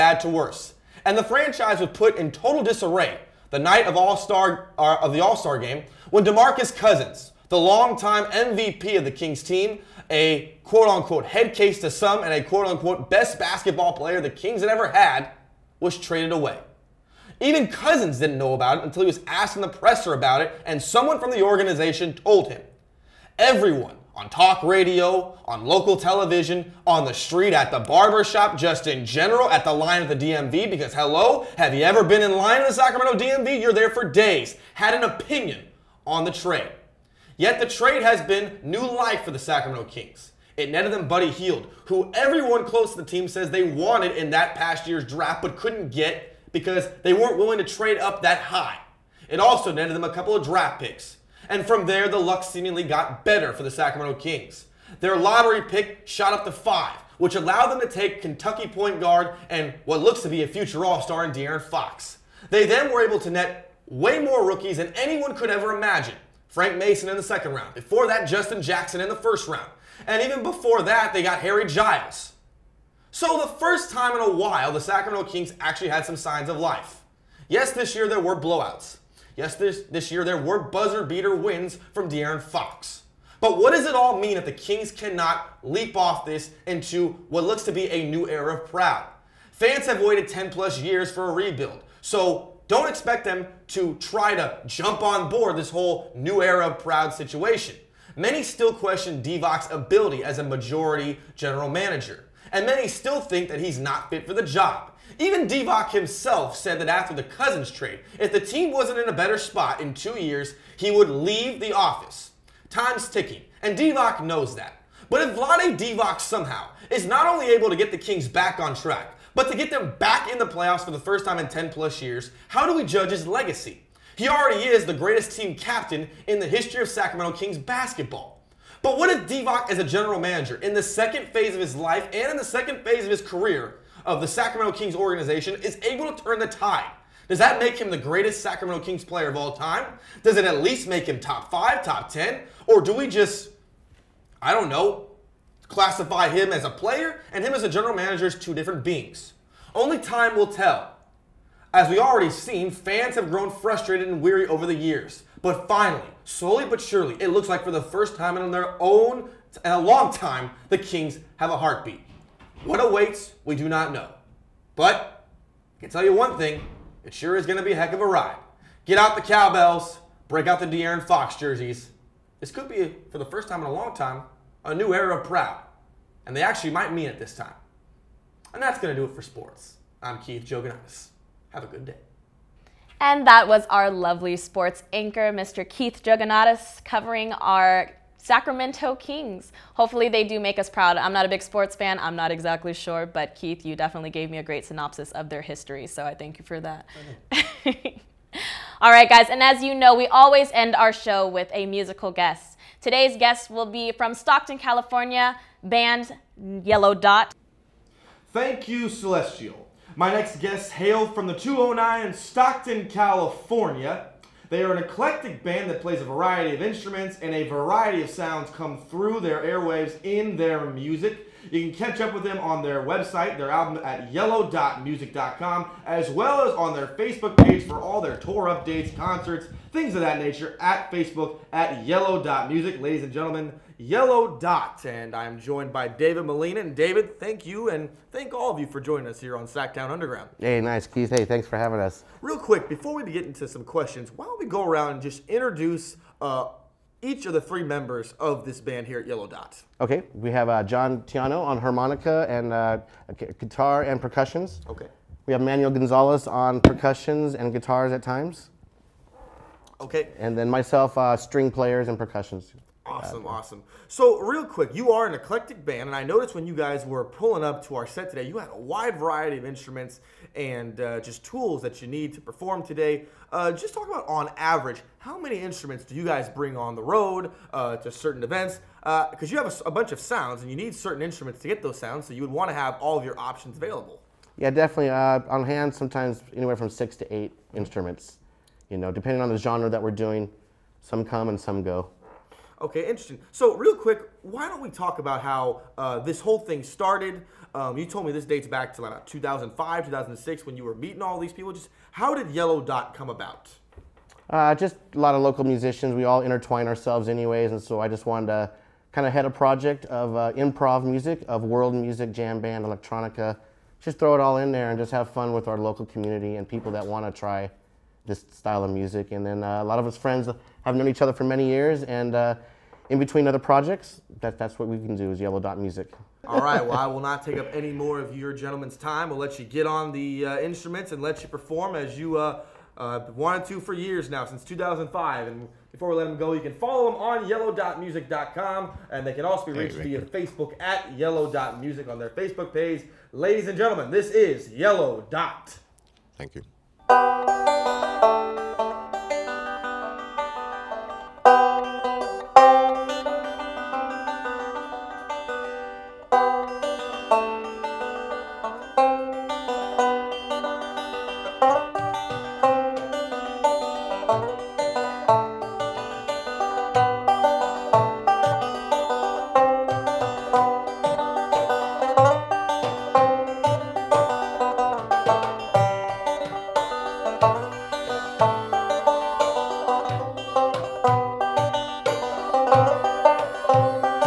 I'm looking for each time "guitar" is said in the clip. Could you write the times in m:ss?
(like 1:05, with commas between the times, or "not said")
4:13, 4:17.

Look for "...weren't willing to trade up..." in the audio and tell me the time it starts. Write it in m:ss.
0:47.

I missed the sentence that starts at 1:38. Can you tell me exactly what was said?
Many still question Divac's ability as a majority general manager and many still think that he's not fit for the job.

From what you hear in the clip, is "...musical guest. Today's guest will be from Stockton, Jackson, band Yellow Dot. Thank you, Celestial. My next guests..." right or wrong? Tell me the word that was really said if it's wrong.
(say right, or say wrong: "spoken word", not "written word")
wrong: "California", not "Jackson".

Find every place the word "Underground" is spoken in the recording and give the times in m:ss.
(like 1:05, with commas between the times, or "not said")
3:59.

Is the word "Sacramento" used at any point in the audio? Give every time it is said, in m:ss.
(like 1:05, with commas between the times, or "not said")
0:32, 0:39, 0:53, 1:14, 2:06, 2:14, 2:18, 3:08.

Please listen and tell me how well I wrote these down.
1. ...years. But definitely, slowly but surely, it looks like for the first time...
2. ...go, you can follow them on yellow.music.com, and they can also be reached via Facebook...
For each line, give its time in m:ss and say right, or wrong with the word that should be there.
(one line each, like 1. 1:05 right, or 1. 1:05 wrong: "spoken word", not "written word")
1. 2:34 wrong: "finally", not "definitely"
2. 5:36 right.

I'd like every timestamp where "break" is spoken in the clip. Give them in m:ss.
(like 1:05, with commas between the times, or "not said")
2:50.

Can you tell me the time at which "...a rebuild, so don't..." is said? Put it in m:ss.
1:31.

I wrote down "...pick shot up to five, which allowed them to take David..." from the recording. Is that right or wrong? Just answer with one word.
wrong.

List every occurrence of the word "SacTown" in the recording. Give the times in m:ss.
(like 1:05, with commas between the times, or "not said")
3:59.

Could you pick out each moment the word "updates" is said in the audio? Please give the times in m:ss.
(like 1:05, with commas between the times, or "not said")
3:48.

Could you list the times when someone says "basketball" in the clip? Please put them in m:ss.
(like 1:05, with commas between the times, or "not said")
0:13, 2:07.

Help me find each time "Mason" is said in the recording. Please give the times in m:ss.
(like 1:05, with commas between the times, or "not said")
1:06.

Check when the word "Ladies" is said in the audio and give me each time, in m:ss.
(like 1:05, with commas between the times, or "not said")
3:52, 5:43.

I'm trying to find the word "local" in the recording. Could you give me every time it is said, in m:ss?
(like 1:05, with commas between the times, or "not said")
0:25, 5:05, 5:15.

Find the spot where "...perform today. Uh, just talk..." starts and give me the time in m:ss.
4:32.